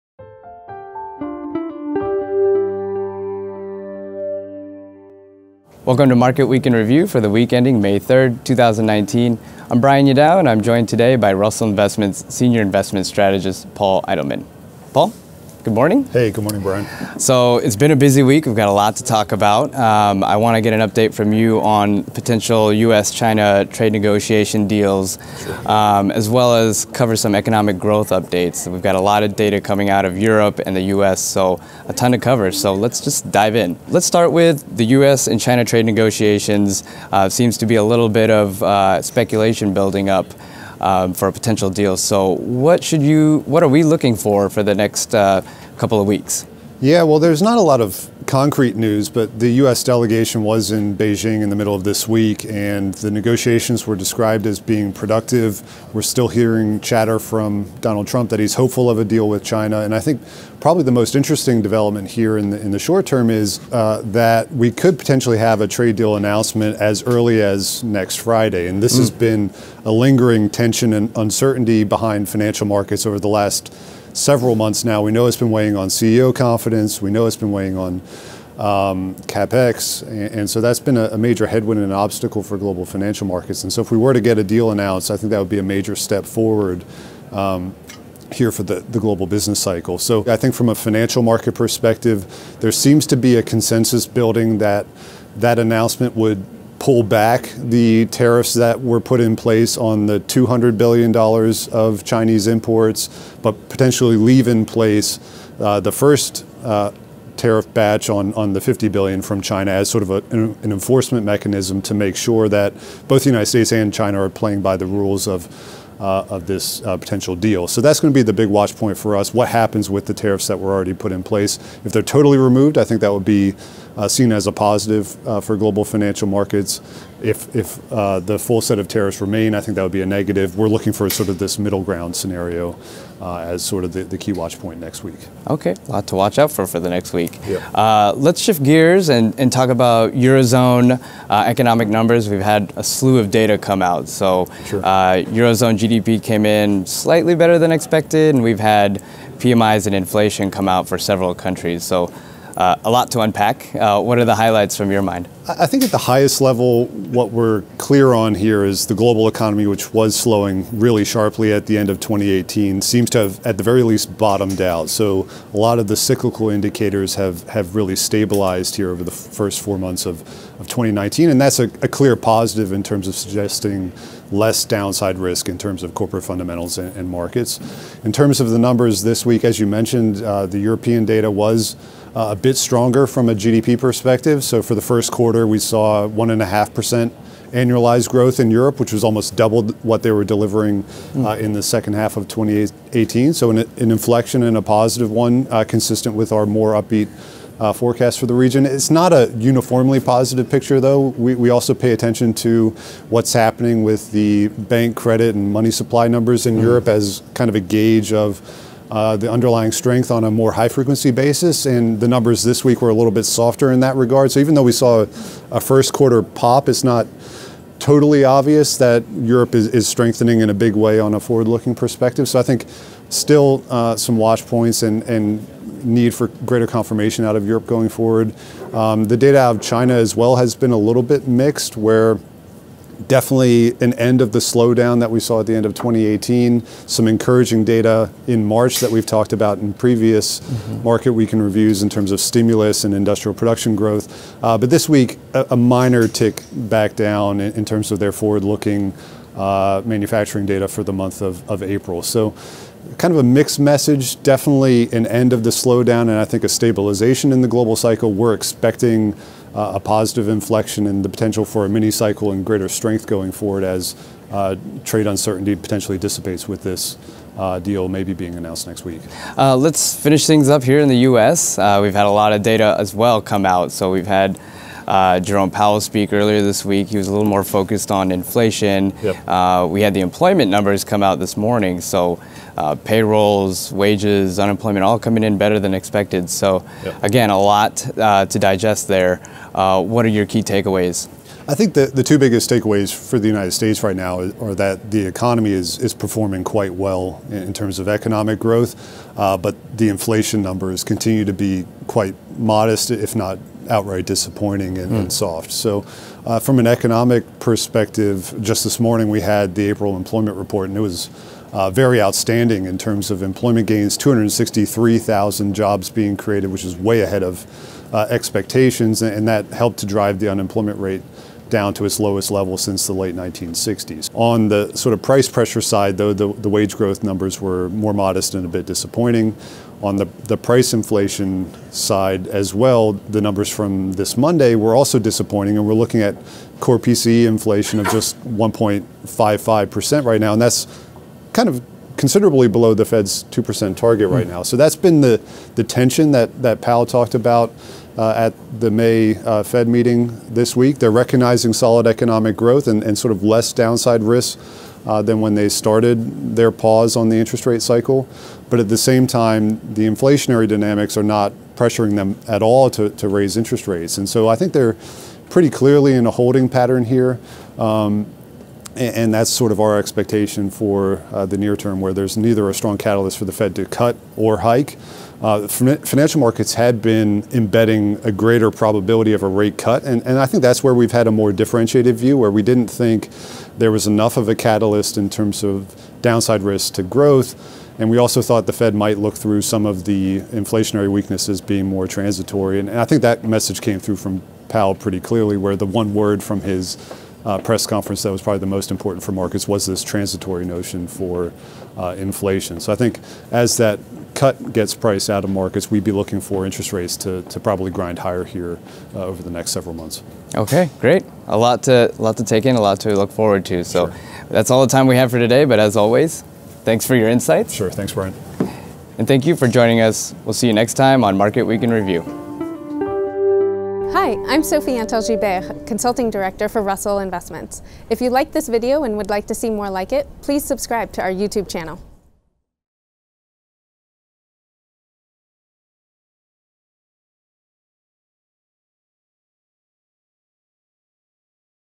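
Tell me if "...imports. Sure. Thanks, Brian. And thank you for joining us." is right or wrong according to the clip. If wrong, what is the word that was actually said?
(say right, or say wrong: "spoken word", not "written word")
wrong: "insights", not "imports".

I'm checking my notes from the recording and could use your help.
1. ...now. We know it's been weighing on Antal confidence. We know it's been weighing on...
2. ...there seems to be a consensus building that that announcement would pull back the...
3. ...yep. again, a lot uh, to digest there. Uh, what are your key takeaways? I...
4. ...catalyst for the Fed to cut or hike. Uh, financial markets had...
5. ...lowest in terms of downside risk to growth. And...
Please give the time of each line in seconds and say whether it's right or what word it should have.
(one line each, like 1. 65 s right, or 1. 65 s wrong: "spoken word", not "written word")
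1. 74 s wrong: "CEO", not "Antal"
2. 92 s right
3. 286 s right
4. 372 s right
5. 384 s wrong: "catalyst", not "lowest".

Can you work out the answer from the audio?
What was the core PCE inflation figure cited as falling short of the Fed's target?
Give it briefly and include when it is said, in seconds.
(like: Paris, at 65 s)
1.55%, at 338 s.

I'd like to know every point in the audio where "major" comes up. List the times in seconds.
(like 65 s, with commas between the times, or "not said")
81 s, 85 s.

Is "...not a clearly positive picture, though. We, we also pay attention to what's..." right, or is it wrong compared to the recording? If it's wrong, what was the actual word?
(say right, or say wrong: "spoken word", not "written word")
wrong: "uniformly", not "clearly".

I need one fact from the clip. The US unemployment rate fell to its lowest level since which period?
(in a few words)
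the late 1960s.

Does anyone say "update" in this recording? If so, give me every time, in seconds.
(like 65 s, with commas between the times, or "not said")
20 s, 28 s.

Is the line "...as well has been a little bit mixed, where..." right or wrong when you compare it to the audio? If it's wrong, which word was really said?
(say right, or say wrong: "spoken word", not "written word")
right.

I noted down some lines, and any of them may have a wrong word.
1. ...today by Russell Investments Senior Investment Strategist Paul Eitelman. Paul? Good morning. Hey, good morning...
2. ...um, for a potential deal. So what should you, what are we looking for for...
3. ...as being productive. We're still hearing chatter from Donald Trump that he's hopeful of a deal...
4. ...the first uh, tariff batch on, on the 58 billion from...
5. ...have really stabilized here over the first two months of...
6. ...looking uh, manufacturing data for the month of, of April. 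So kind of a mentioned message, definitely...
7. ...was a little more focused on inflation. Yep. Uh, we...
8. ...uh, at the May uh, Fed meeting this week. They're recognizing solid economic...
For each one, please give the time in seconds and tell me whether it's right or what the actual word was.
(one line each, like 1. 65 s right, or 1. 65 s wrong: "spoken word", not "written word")
1. 10 s right
2. 40 s right
3. 54 s right
4. 105 s wrong: "50", not "58"
5. 167 s wrong: "four", not "two"
6. 248 s wrong: "mixed", not "mentioned"
7. 276 s right
8. 347 s right.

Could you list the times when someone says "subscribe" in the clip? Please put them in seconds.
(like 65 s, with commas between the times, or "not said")
430 s.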